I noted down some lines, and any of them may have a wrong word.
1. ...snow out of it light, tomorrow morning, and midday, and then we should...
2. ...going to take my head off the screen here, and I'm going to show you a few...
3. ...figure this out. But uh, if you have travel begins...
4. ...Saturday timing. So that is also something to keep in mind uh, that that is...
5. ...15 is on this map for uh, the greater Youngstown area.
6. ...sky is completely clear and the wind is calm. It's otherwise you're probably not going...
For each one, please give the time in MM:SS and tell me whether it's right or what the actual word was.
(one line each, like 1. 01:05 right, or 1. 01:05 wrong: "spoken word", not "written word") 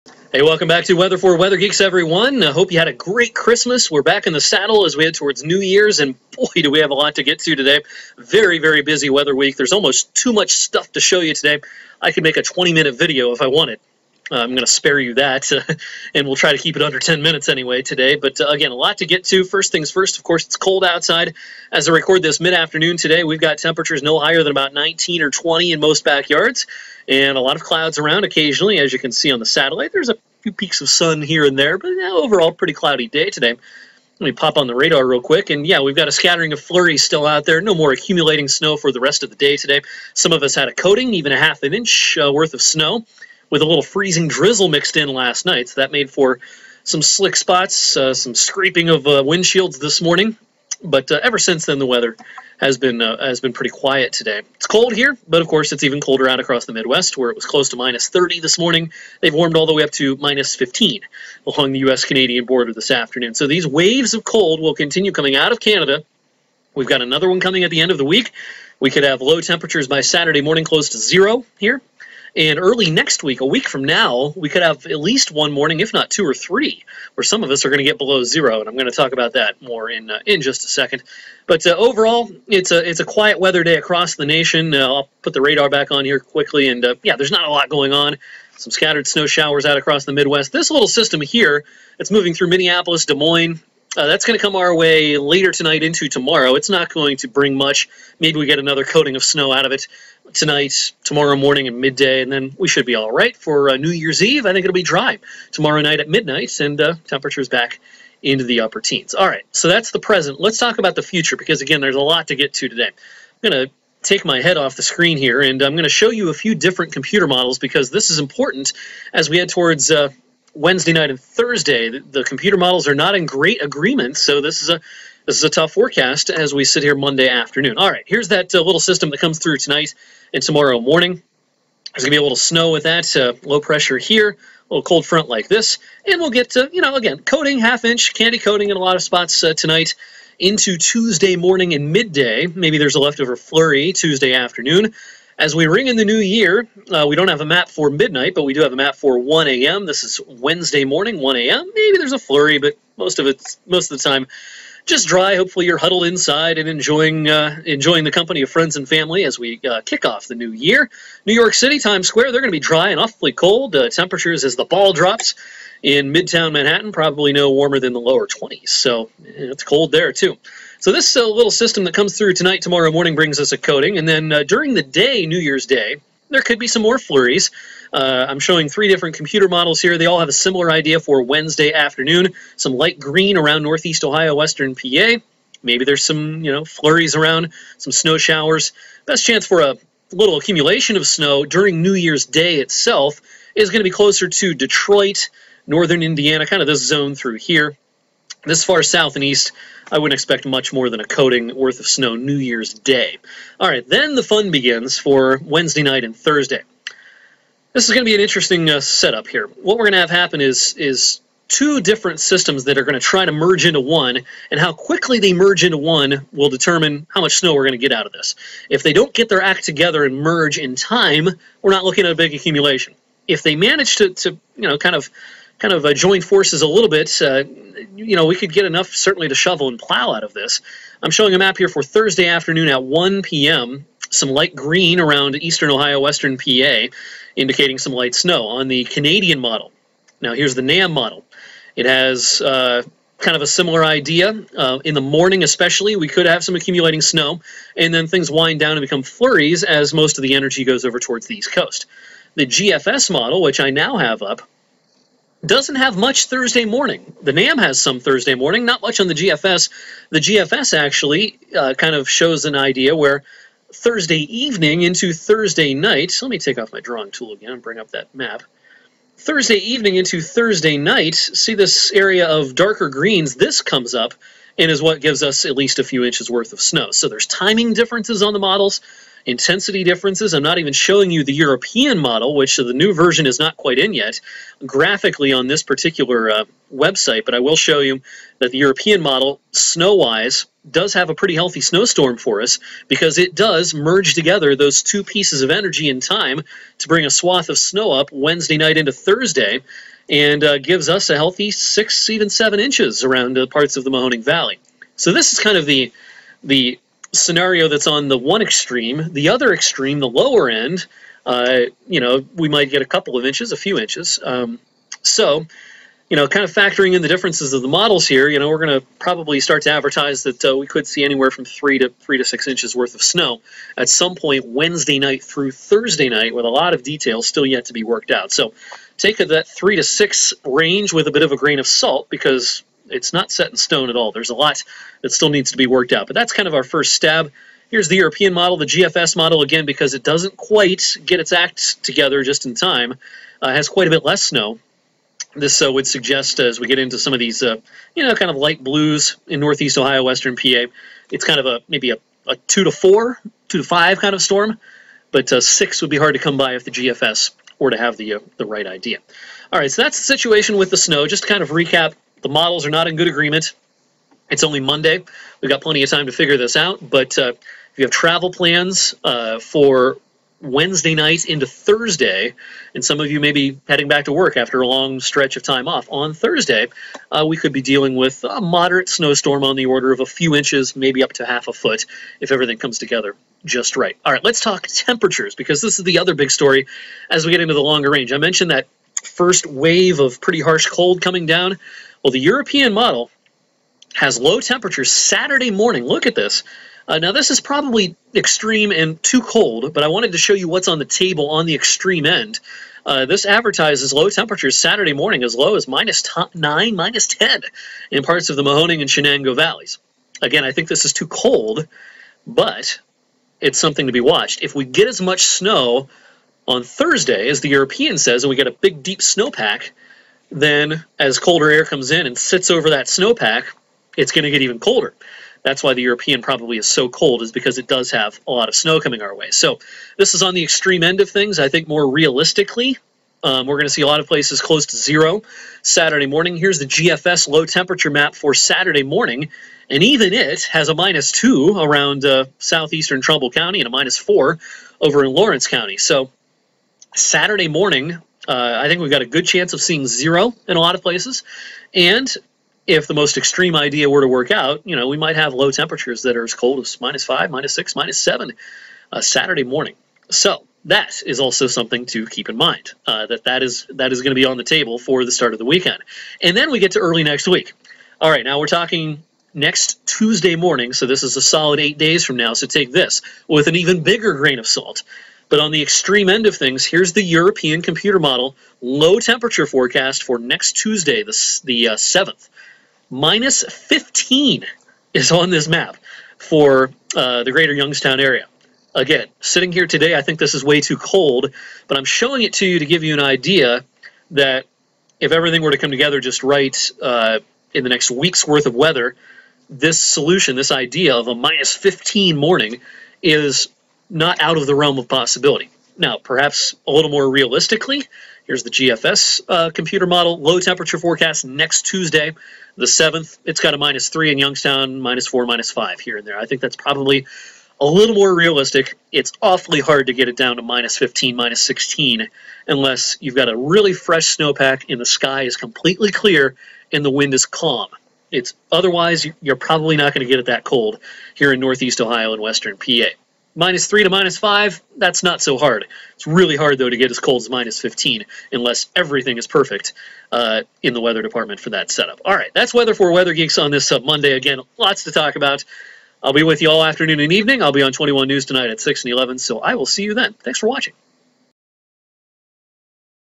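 1. 01:39 wrong: "tonight", not "light"
2. 01:53 right
3. 06:06 wrong: "plans", not "begins"
4. 07:39 wrong: "morning", not "timing"
5. 08:03 right
6. 08:44 right.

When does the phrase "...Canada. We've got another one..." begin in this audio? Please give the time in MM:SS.
01:05.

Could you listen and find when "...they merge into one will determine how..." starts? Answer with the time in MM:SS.
03:35.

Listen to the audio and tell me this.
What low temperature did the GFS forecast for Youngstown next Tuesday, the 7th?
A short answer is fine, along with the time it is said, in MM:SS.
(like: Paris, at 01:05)
minus 3, at 08:33.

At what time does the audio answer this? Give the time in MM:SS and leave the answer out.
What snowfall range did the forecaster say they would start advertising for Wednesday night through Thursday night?
05:21.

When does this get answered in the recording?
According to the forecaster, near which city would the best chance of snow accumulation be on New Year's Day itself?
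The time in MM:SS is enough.
03:14.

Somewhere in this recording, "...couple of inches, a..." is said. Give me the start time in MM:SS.
05:12.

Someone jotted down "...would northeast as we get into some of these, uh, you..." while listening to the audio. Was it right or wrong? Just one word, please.
wrong.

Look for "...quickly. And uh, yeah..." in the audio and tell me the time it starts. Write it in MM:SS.
01:26.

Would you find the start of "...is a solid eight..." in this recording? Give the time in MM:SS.
07:51.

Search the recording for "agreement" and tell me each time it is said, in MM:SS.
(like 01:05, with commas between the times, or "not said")
02:03, 06:03.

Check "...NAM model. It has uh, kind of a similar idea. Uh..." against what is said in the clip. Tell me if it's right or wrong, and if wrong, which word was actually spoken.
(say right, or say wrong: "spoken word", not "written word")
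right.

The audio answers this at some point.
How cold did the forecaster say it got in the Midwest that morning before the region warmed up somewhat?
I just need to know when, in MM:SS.
00:57.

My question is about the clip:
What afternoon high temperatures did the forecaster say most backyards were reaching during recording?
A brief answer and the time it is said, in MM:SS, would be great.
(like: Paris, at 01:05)
19 or 20, at 00:24.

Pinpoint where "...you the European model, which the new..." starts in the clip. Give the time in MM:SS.
04:41.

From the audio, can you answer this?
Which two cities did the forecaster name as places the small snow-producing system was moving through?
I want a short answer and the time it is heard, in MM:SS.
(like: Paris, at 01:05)
Minneapolis, Des Moines, at 01:32.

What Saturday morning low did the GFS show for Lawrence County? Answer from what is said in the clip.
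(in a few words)
minus 4.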